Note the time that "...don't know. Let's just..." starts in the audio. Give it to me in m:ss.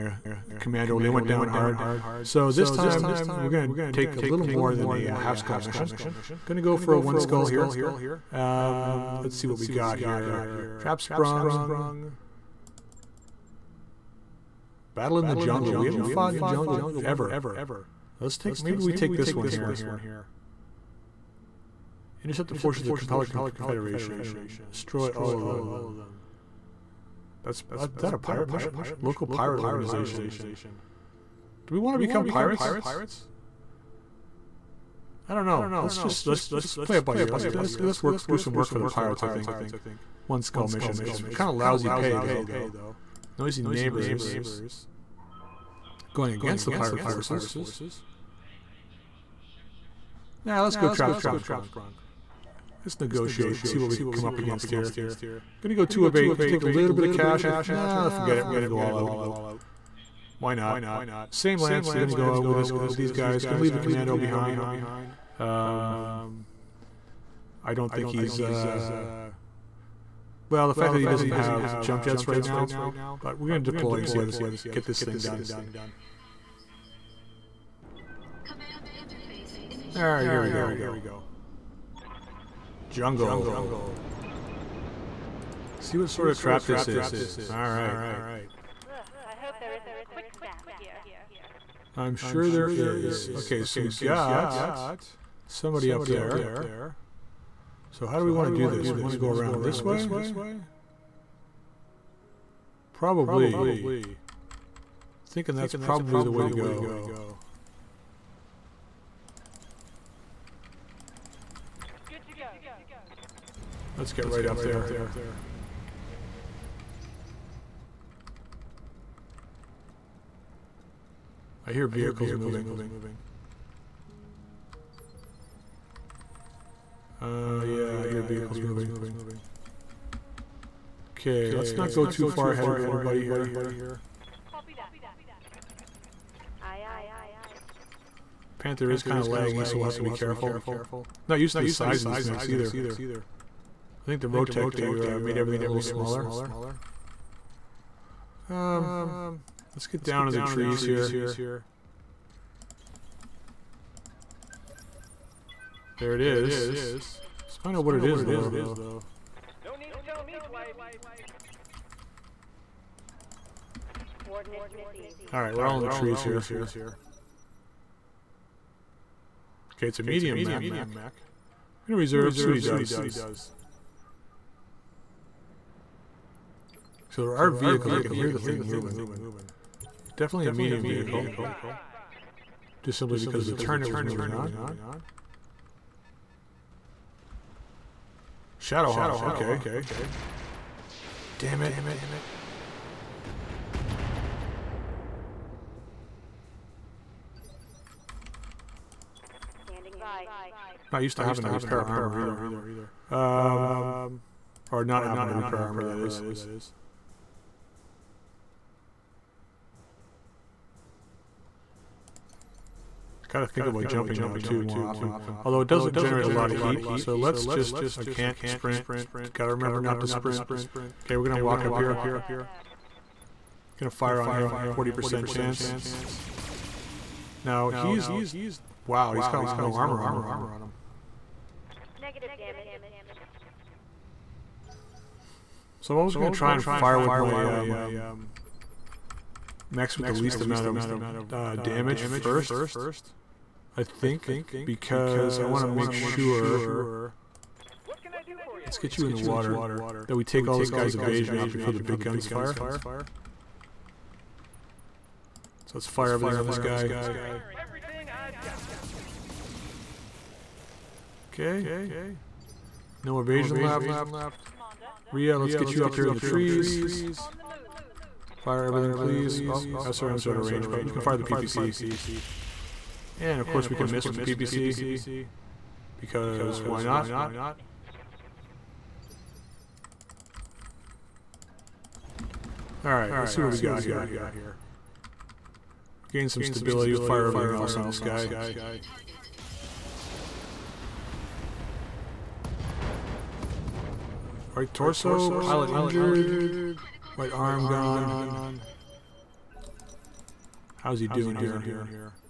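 0:35.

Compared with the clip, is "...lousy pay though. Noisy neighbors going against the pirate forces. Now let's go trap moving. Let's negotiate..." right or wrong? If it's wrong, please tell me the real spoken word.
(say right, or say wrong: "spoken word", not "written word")
wrong: "sprung", not "moving".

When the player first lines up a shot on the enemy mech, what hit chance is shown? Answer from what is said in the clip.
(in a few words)
40%.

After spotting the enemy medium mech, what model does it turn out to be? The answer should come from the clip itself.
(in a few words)
Shadowhawk.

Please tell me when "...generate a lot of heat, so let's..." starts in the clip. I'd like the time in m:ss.
3:35.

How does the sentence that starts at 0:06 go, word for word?
Going to go for a one skull here.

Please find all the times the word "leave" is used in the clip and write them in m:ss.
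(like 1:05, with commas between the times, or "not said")
1:03.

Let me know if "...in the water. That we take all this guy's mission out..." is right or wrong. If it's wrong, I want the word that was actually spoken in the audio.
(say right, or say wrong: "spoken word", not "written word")
wrong: "evasion", not "mission".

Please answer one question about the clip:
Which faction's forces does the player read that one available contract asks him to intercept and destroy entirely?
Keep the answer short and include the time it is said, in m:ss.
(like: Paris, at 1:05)
Capellan Confederation, at 0:23.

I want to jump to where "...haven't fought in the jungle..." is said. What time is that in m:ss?
0:15.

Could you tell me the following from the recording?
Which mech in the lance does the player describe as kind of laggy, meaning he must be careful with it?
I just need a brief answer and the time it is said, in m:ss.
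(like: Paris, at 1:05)
Panther, at 2:18.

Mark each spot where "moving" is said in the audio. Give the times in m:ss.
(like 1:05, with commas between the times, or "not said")
2:02, 2:08, 2:58, 3:04.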